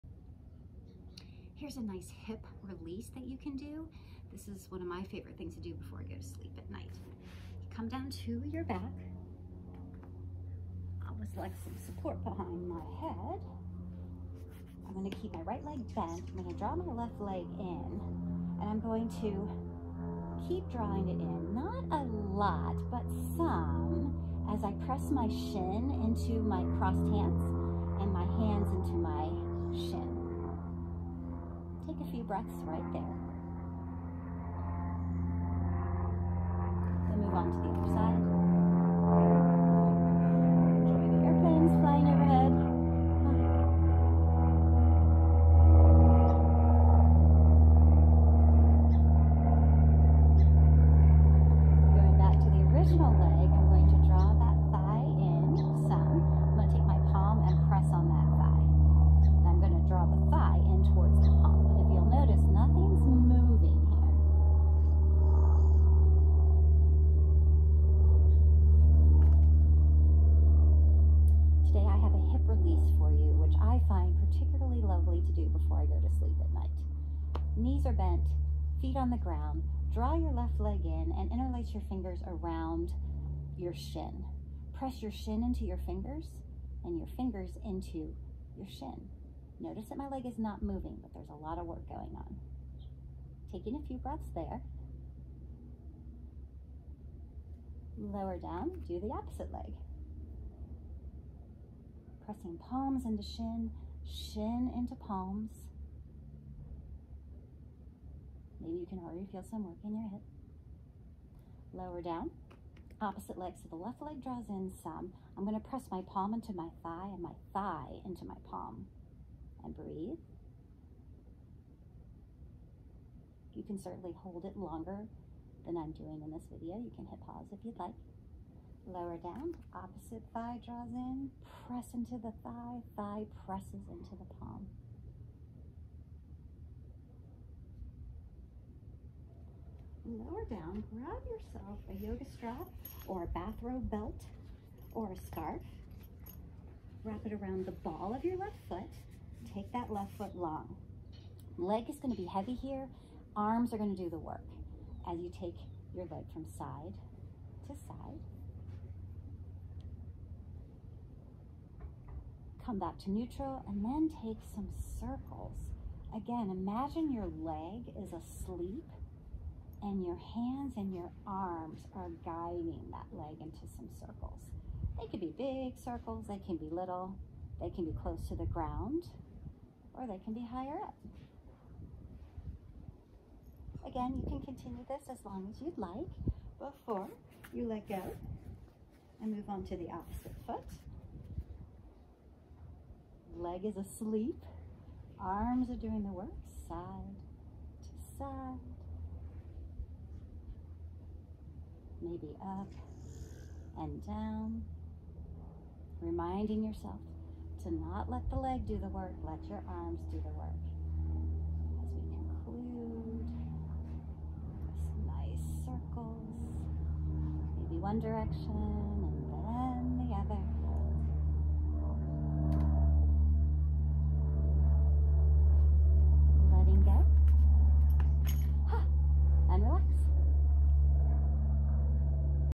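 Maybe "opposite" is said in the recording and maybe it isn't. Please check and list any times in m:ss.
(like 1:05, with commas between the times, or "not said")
1:39, 1:53, 2:09, 3:09.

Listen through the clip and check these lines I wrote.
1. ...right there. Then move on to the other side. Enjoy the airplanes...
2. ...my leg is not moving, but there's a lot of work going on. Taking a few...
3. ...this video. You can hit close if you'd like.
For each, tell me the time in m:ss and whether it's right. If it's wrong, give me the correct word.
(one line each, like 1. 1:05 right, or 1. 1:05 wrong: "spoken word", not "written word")
1. 0:32 right
2. 1:29 right
3. 2:06 wrong: "pause", not "close".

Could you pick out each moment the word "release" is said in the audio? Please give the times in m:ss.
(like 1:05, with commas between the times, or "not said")
0:02, 1:12.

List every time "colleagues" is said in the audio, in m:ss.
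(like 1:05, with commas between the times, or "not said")
not said.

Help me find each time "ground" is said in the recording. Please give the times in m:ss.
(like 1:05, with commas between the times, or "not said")
1:19, 2:58.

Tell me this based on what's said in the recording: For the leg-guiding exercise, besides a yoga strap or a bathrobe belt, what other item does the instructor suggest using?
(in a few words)
a scarf.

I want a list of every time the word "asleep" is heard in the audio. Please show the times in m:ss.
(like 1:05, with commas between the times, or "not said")
2:48, 3:13.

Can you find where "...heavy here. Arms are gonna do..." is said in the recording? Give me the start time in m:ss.
2:32.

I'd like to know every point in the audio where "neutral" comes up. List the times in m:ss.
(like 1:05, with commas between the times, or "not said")
2:43.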